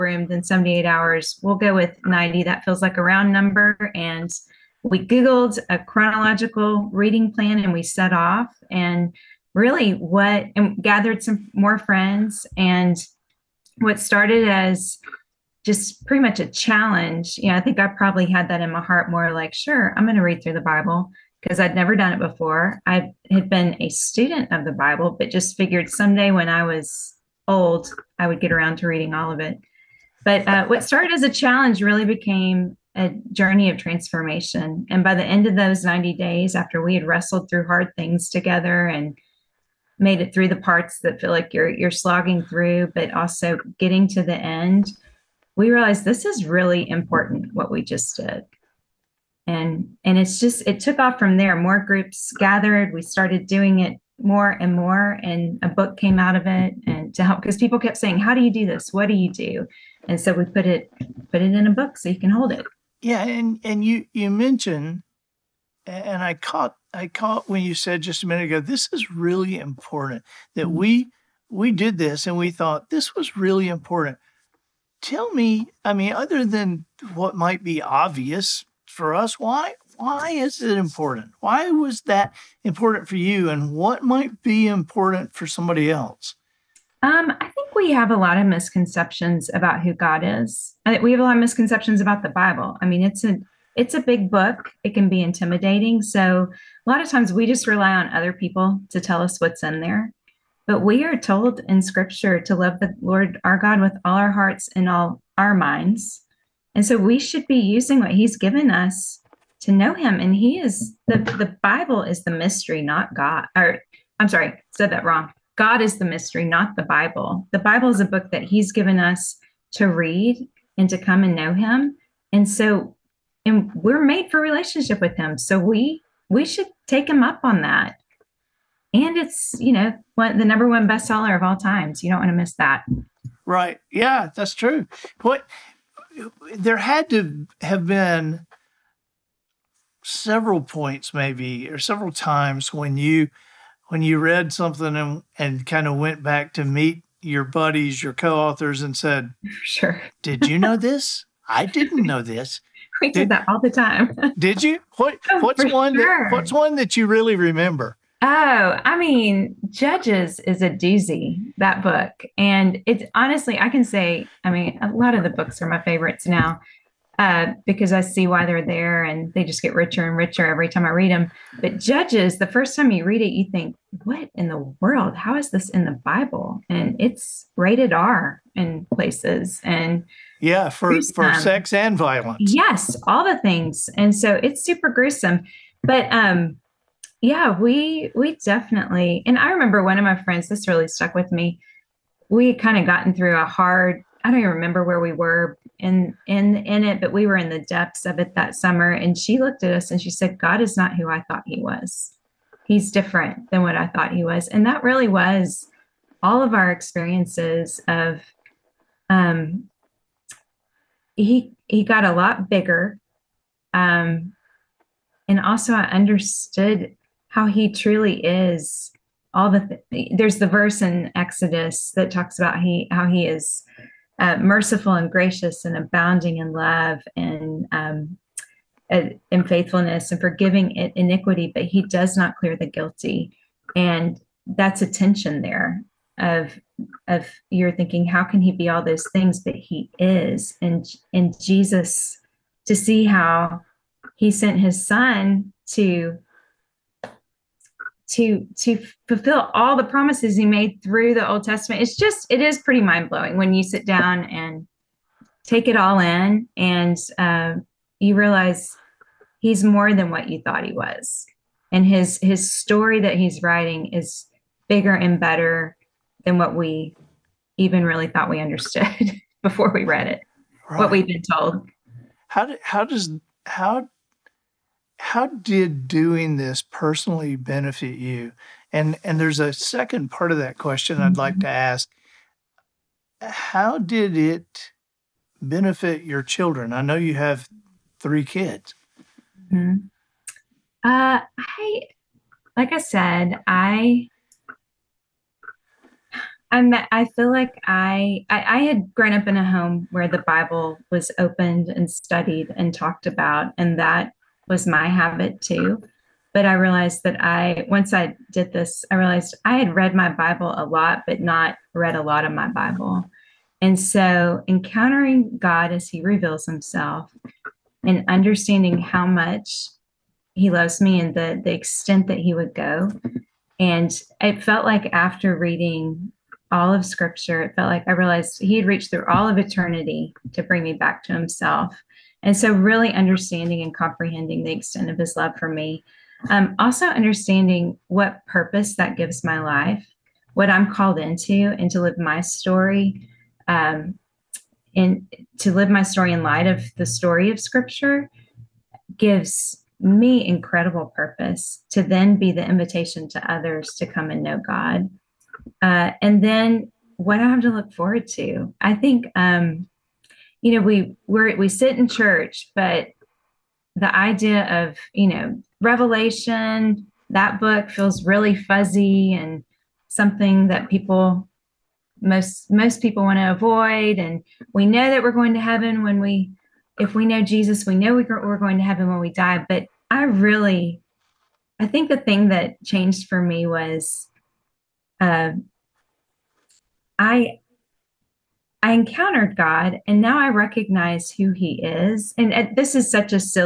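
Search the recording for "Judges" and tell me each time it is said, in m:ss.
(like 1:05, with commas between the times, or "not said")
2:39, 2:51.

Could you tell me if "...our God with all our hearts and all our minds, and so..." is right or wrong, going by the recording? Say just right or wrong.
right.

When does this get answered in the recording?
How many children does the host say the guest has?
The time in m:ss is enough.
4:47.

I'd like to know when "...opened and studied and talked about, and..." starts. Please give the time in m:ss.
5:01.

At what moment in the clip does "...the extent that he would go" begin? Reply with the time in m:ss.
5:21.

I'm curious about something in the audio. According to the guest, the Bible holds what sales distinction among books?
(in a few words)
number one bestseller.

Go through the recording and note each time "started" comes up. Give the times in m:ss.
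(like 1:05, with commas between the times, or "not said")
0:13, 0:30, 0:53.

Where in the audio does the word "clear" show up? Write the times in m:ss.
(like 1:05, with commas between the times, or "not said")
3:52.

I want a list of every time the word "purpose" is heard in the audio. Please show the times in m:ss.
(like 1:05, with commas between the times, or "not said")
5:38, 5:50.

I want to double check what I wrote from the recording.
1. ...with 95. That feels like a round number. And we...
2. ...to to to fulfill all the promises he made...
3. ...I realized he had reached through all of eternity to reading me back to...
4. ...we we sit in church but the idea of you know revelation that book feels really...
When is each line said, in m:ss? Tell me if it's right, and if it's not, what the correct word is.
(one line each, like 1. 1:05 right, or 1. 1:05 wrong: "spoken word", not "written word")
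1. 0:01 wrong: "90", not "95"
2. 4:05 right
3. 5:27 wrong: "bring", not "reading"
4. 6:01 right.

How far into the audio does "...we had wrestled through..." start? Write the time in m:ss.
0:36.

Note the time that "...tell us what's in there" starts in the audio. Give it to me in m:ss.
1:38.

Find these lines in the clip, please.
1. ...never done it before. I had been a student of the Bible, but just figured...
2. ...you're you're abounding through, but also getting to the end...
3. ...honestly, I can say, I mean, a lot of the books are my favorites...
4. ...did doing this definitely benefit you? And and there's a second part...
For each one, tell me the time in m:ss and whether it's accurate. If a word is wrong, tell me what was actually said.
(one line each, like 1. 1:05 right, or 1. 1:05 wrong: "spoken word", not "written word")
1. 0:21 right
2. 0:41 wrong: "slogging", not "abounding"
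3. 2:43 right
4. 4:35 wrong: "personally", not "definitely".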